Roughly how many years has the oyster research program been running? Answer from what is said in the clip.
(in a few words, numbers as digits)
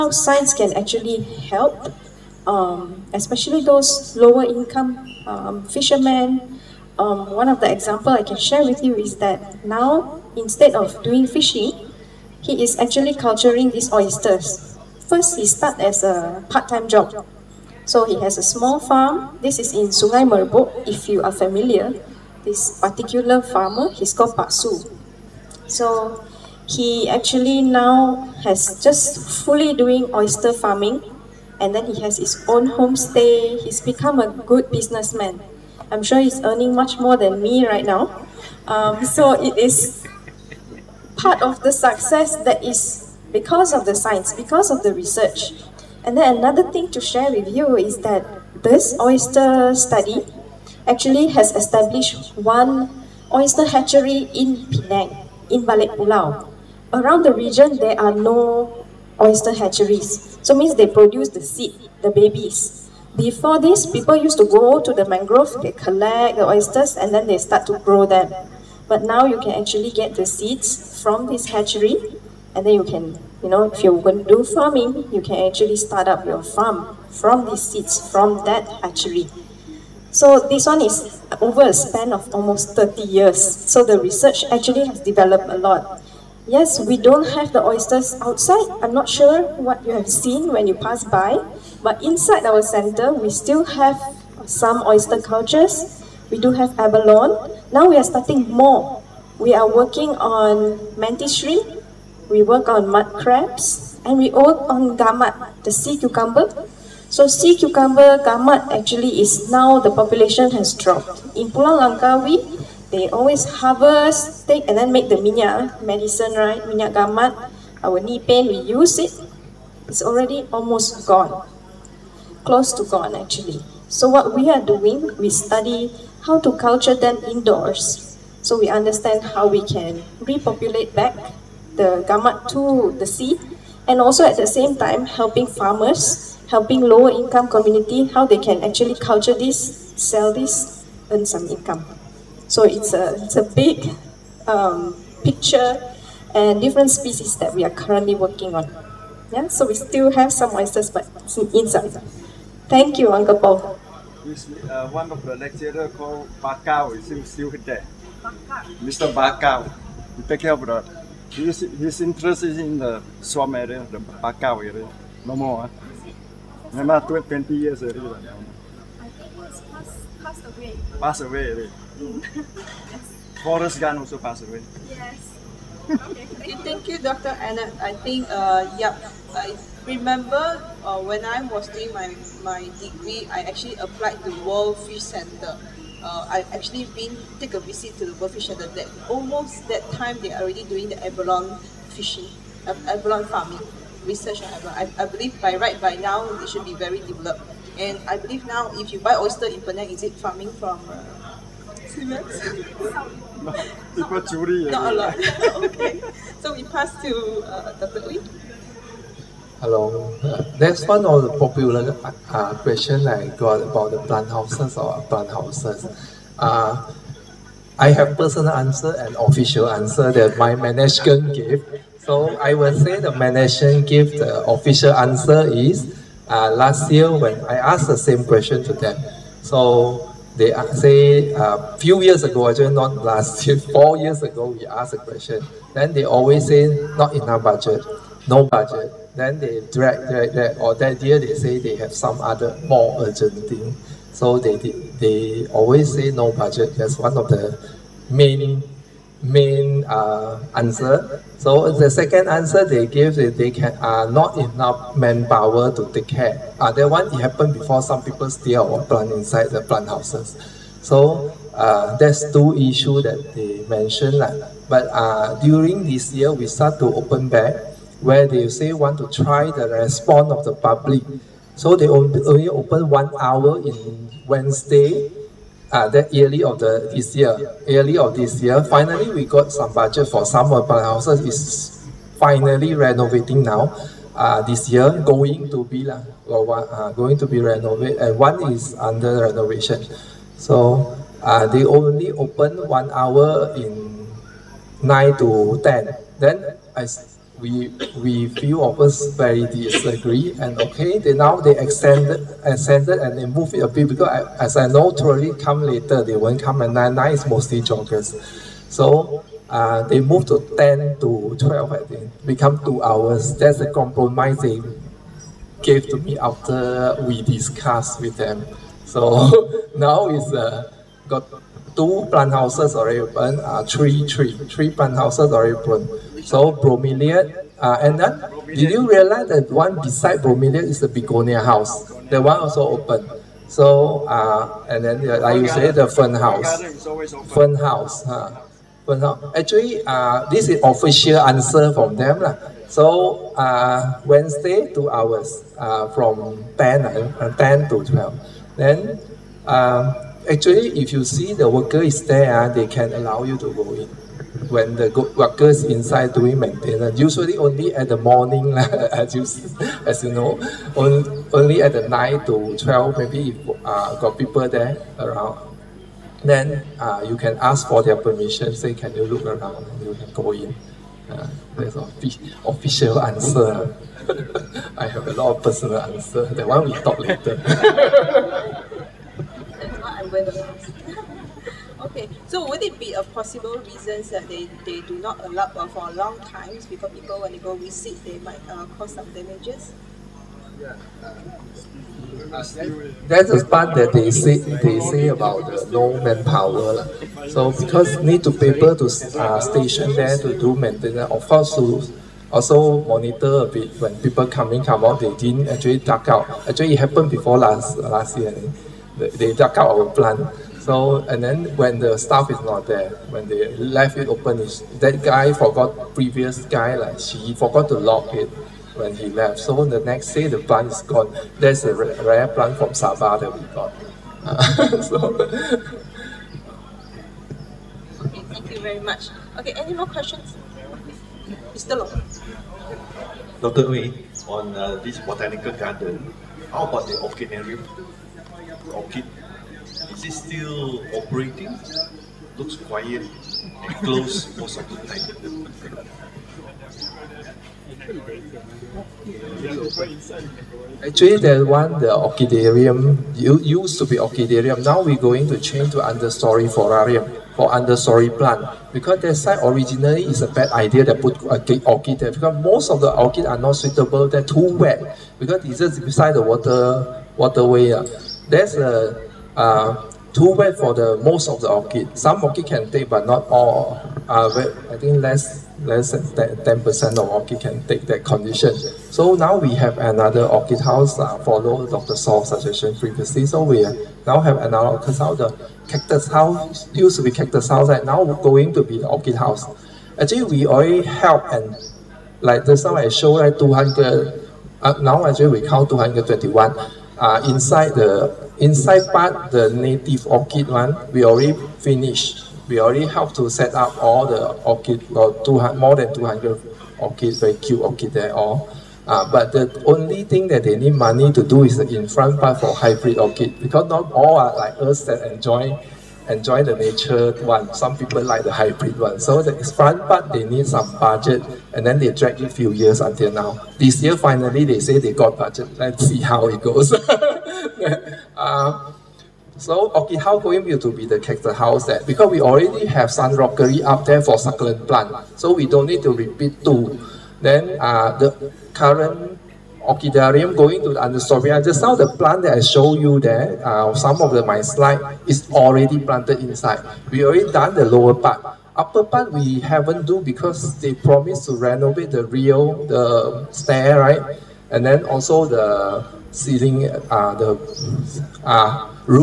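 30 years.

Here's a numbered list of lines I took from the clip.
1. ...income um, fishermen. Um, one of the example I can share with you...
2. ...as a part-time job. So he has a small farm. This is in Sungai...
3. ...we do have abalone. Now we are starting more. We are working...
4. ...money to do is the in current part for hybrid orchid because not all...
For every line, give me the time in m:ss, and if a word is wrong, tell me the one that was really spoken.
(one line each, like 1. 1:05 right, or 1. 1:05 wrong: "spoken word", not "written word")
1. 0:04 right
2. 0:15 right
3. 1:36 right
4. 8:30 wrong: "front", not "current".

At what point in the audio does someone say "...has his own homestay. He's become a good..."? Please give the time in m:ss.
0:32.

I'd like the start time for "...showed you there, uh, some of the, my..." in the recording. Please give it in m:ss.
9:02.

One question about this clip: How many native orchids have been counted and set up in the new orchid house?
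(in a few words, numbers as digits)
221.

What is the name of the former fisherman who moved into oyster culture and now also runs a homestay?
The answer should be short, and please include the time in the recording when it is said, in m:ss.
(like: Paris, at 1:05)
Pak Su, at 0:24.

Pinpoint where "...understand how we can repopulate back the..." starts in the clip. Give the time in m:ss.
2:08.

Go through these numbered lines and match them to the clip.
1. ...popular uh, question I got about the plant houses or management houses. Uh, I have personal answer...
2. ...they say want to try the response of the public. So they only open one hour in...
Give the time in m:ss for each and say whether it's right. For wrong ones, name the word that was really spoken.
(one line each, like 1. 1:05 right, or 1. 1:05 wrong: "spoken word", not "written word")
1. 3:31 wrong: "plant", not "management"
2. 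4:28 right.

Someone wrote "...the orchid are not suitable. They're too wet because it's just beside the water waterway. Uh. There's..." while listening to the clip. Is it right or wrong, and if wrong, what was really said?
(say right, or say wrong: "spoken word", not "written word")
right.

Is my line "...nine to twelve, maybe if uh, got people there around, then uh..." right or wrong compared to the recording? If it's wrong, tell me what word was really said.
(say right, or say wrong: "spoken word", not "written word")
right.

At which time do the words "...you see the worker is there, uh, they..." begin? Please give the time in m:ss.
5:50.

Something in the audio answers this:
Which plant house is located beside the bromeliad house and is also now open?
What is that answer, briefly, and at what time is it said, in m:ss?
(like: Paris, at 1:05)
Begonia house, at 5:30.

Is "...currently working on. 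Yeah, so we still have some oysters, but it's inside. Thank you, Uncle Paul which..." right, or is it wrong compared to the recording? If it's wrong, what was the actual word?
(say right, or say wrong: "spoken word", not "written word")
right.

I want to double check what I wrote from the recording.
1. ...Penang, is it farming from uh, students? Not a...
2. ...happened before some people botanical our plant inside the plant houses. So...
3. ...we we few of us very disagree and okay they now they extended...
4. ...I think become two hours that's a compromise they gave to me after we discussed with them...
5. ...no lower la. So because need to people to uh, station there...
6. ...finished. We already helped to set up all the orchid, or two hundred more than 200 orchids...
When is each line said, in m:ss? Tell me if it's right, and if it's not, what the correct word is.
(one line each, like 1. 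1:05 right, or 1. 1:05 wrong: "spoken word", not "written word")
1. 3:19 right
2. 4:17 wrong: "steal", not "botanical"
3. 4:57 right
4. 5:11 right
5. 6:35 wrong: "manpower", not "lower"
6. 8:21 right.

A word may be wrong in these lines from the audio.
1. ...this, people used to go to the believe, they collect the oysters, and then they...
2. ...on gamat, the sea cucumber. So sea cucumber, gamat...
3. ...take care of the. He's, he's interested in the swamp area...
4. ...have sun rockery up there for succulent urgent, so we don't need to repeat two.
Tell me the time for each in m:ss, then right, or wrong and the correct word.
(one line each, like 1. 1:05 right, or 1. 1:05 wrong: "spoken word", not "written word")
1. 1:03 wrong: "mangrove", not "believe"
2. 1:44 right
3. 2:40 right
4. 8:52 wrong: "plant", not "urgent".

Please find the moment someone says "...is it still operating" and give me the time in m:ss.
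7:19.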